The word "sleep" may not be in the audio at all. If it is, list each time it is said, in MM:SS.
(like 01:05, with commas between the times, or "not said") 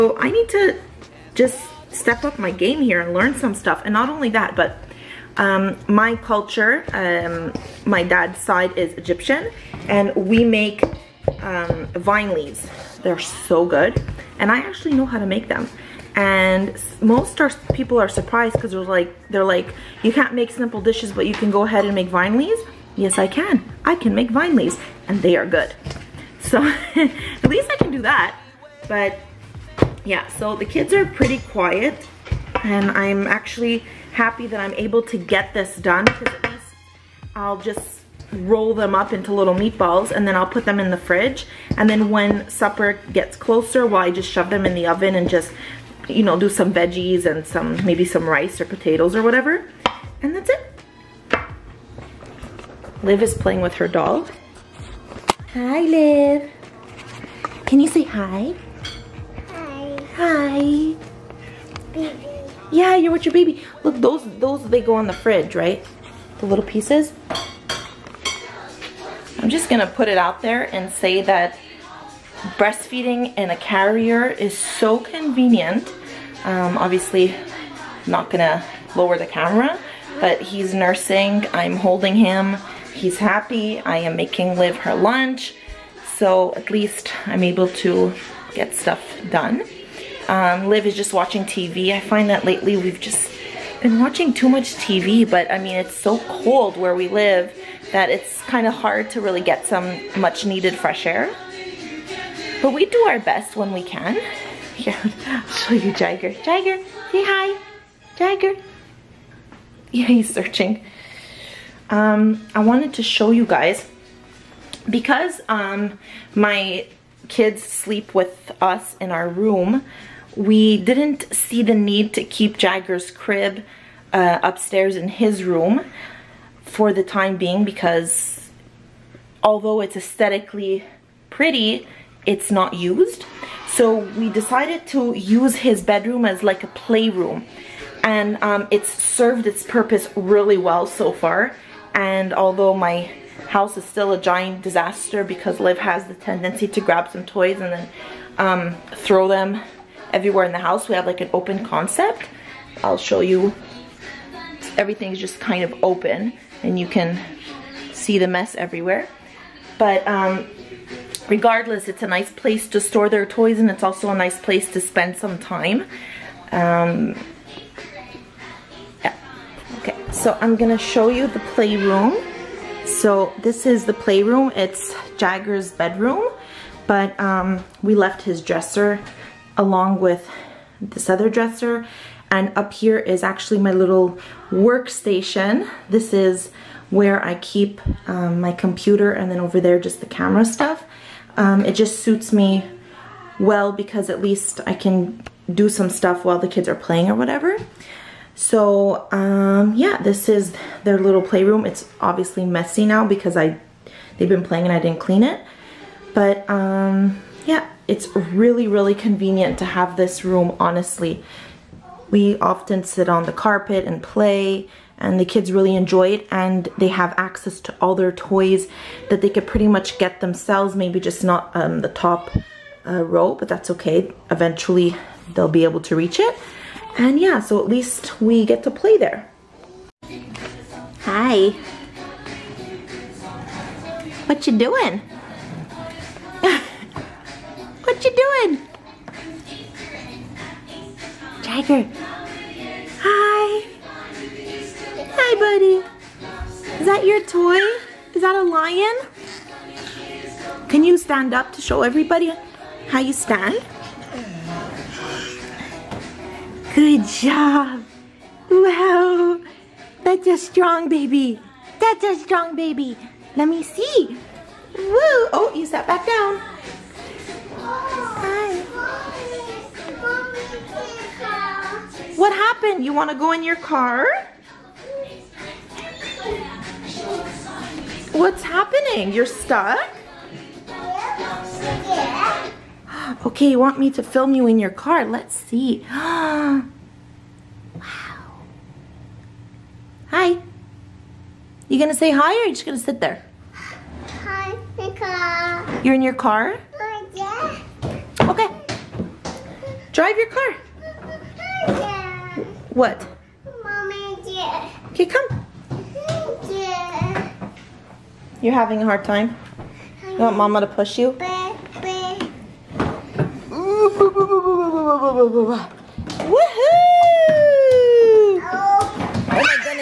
01:57.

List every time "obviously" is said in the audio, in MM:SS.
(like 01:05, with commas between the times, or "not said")
01:16, 03:22.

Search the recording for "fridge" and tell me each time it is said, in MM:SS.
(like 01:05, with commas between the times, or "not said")
00:40, 01:05.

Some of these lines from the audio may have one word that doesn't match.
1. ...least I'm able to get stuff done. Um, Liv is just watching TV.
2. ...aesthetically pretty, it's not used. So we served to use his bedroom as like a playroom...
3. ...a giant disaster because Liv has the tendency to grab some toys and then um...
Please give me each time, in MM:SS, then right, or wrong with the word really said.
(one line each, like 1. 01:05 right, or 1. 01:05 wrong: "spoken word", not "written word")
1. 01:26 right
2. 02:09 wrong: "decided", not "served"
3. 02:24 right.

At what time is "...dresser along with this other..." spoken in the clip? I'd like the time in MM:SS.
02:58.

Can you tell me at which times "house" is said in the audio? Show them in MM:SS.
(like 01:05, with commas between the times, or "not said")
02:23, 02:30.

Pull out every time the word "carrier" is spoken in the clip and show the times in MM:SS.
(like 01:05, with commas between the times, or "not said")
01:13.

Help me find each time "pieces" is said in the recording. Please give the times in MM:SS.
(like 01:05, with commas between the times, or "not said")
01:06.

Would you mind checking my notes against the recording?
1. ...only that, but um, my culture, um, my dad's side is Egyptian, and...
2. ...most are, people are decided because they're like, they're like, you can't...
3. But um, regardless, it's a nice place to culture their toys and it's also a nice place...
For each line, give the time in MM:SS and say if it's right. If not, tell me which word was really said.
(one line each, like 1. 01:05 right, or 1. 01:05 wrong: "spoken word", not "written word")
1. 00:04 right
2. 00:16 wrong: "surprised", not "decided"
3. 02:39 wrong: "store", not "culture".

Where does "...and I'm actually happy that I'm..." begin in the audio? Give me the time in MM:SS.
00:32.